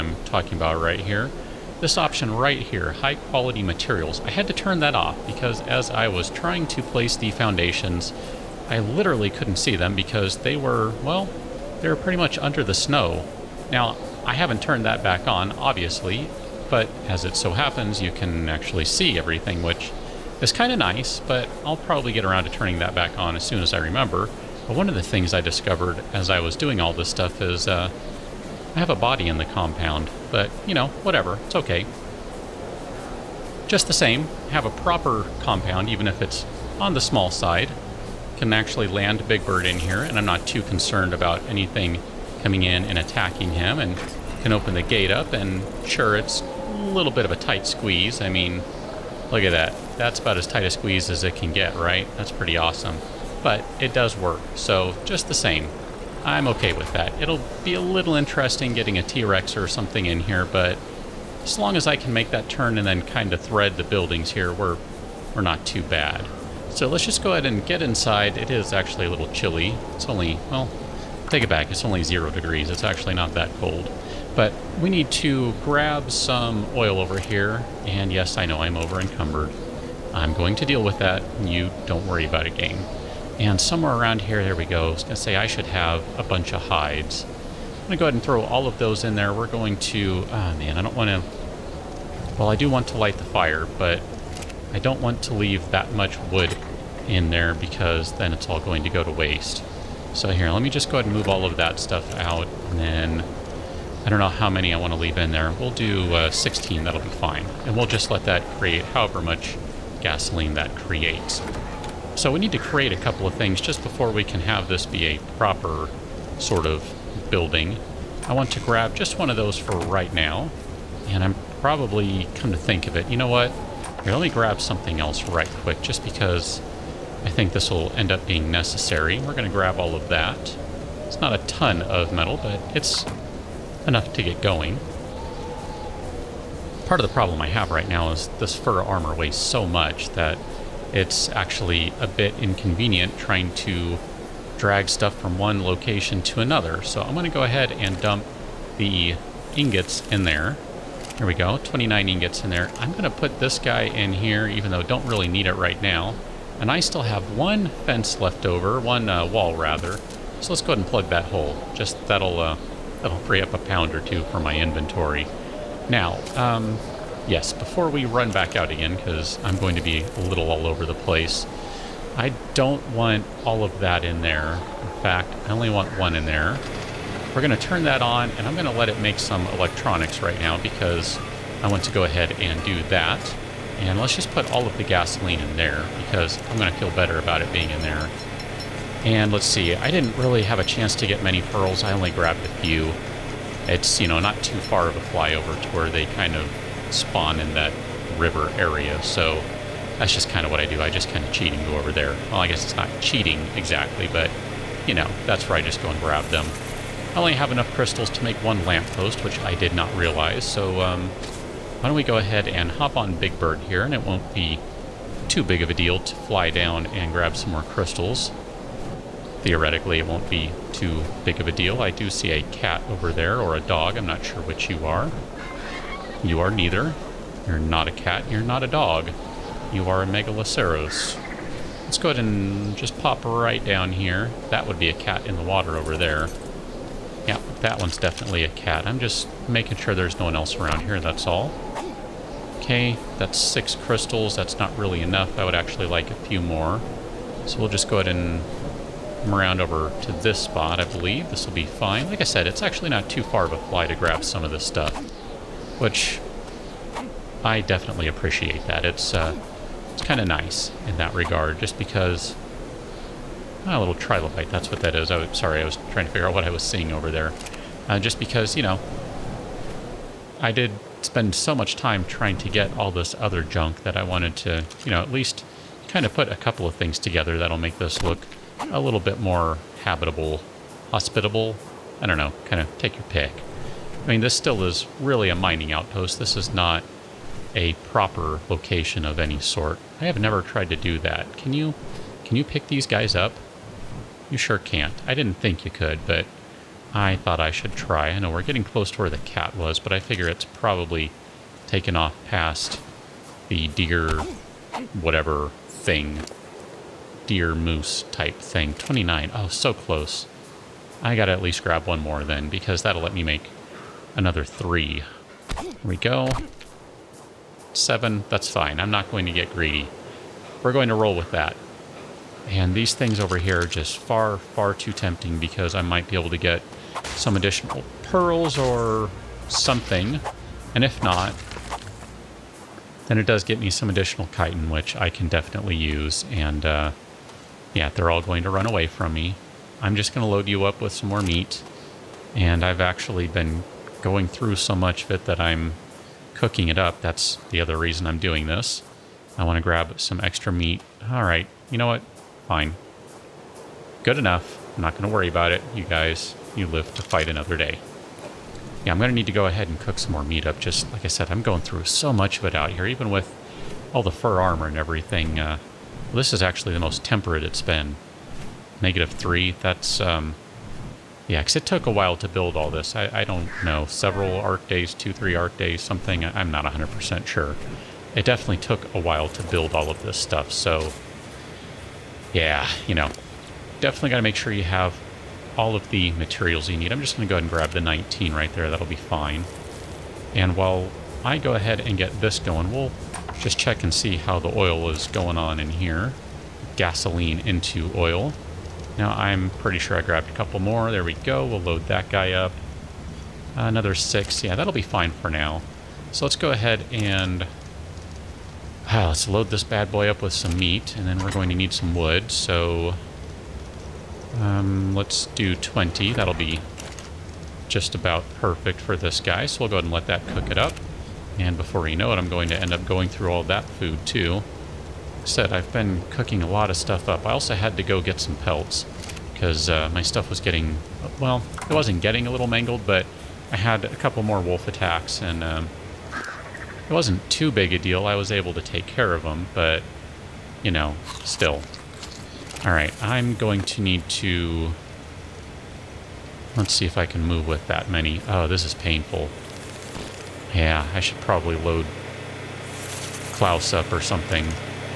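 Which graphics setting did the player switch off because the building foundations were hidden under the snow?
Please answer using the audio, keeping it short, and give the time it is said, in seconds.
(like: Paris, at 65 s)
High quality materials, at 2 s.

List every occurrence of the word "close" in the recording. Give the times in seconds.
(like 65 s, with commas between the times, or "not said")
298 s, 309 s.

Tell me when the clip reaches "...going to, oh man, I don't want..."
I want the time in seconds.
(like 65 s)
89 s.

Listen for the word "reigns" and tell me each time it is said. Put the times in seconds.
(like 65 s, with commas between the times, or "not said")
not said.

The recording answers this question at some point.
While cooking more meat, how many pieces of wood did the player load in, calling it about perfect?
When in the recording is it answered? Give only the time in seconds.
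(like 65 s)
415 s.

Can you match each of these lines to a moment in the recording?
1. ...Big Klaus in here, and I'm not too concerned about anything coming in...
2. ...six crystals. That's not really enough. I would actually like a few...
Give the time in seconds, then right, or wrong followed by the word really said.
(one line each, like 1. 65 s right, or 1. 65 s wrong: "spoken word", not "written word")
1. 39 s wrong: "Bird", not "Klaus"
2. 243 s right.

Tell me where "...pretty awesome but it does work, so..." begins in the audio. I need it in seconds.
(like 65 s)
52 s.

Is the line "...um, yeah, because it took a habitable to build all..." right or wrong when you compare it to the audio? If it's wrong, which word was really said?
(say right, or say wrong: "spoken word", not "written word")
wrong: "while", not "habitable".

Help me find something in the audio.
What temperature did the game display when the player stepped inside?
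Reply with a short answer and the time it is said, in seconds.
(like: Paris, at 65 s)
0 degrees, at 72 s.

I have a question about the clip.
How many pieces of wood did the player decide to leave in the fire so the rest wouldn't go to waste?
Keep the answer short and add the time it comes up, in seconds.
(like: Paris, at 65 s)
16, at 106 s.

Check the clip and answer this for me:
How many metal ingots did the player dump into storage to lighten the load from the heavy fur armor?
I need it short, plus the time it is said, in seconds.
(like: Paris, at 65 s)
29, at 151 s.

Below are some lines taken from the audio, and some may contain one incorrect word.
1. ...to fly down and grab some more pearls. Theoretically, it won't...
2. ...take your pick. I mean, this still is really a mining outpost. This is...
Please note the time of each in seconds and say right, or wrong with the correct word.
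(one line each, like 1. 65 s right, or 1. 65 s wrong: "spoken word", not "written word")
1. 215 s wrong: "crystals", not "pearls"
2. 282 s right.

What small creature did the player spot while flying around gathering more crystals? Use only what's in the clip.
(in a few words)
Trilobite.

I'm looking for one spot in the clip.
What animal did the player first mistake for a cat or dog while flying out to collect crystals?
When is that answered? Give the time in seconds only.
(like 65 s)
230 s.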